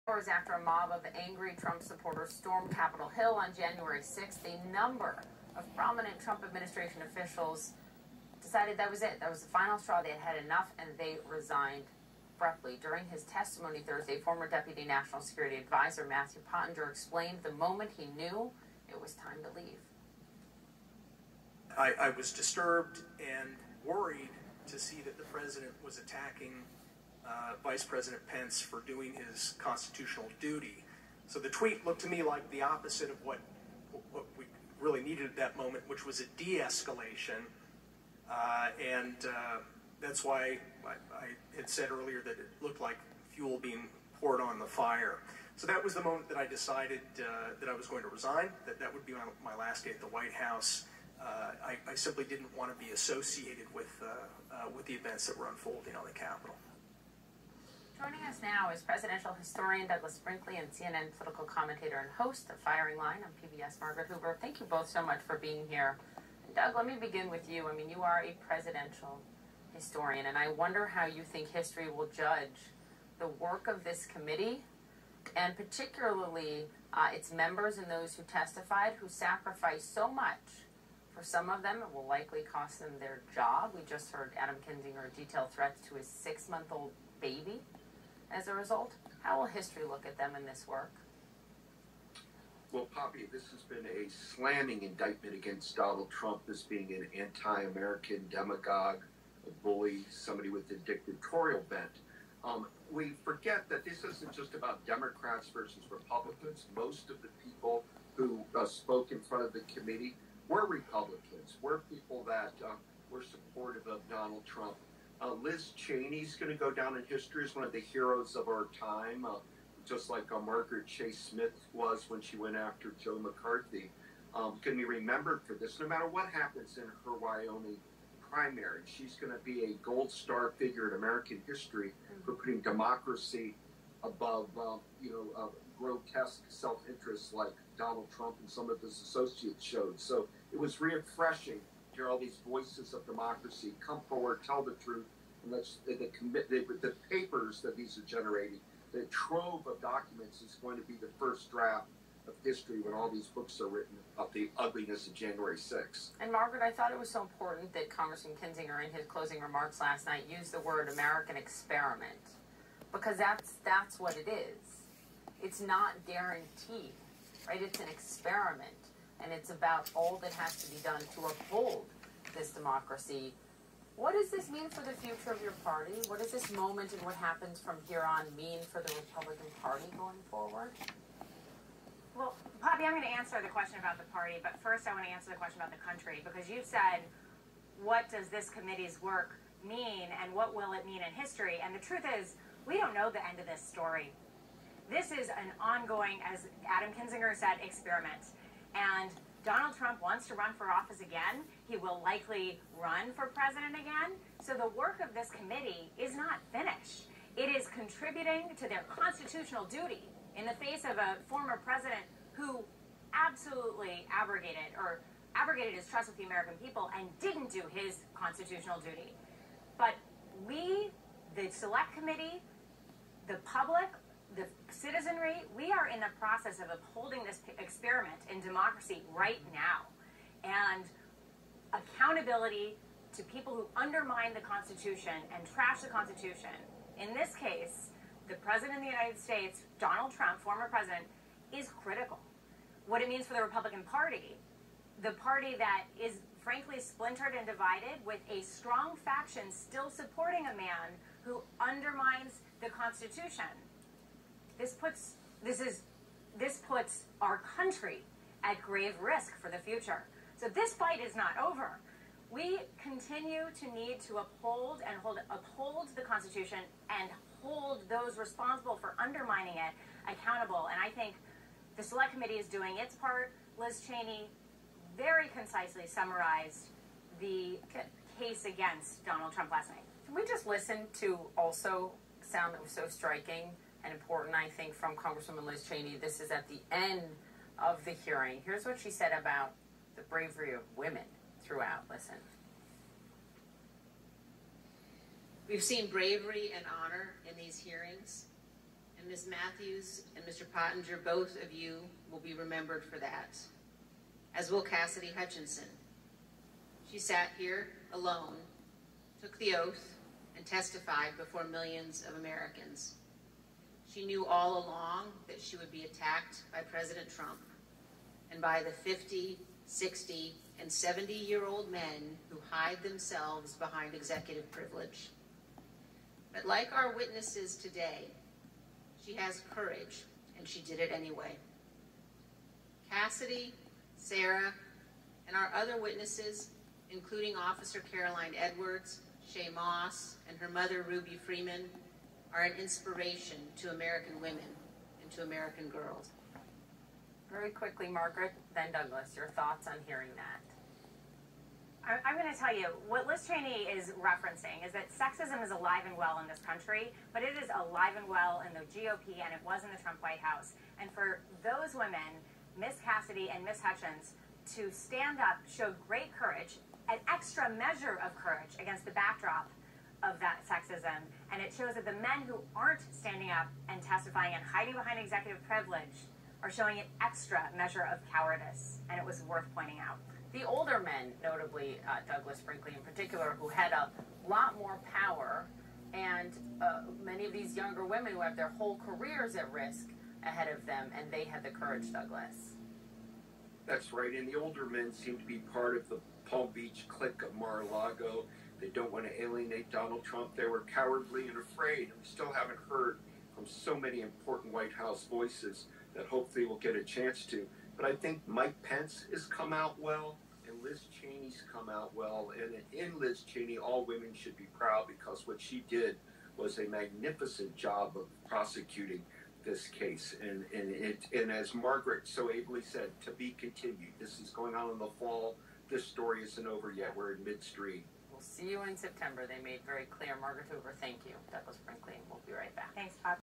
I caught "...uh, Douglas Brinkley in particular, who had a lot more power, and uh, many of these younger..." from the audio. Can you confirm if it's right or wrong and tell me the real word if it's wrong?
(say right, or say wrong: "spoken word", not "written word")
right.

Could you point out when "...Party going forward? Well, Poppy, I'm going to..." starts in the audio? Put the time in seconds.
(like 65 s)
179 s.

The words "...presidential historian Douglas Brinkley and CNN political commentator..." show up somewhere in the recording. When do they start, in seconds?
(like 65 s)
58 s.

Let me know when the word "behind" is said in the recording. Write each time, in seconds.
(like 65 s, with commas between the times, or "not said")
323 s, 374 s.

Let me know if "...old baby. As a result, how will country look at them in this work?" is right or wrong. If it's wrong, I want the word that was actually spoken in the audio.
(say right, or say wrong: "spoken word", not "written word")
wrong: "history", not "country".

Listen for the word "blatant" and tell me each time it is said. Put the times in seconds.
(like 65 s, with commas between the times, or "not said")
not said.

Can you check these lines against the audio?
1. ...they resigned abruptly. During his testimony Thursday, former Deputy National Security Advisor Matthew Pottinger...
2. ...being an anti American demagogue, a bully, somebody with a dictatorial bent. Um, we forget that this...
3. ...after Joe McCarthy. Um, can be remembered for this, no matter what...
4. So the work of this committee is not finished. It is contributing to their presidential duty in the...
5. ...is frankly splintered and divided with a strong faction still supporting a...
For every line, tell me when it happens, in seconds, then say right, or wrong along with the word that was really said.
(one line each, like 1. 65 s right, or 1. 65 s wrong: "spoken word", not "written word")
1. 10 s right
2. 96 s right
3. 122 s right
4. 204 s wrong: "constitutional", not "presidential"
5. 246 s right.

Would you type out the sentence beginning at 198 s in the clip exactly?
And Donald Trump wants to run for office again.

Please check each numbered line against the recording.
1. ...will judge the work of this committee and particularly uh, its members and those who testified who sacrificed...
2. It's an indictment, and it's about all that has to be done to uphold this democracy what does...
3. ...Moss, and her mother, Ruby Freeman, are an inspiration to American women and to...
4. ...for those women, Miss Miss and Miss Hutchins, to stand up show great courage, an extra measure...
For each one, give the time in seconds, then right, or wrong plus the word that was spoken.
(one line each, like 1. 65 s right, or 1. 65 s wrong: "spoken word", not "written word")
1. 71 s right
2. 167 s wrong: "experiment", not "indictment"
3. 339 s right
4. 360 s wrong: "Cassidy", not "Miss".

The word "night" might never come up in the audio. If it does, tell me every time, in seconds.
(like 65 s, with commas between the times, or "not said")
160 s, 279 s.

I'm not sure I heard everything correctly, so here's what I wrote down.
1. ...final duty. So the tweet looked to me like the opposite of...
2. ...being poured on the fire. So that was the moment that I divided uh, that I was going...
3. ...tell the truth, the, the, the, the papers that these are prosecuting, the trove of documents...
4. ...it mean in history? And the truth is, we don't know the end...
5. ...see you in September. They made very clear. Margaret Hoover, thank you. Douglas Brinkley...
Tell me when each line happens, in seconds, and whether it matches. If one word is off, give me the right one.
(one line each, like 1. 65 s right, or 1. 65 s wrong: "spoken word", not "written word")
1. 29 s wrong: "constitutional", not "final"
2. 43 s wrong: "decided", not "divided"
3. 144 s wrong: "generating", not "prosecuting"
4. 190 s right
5. 428 s right.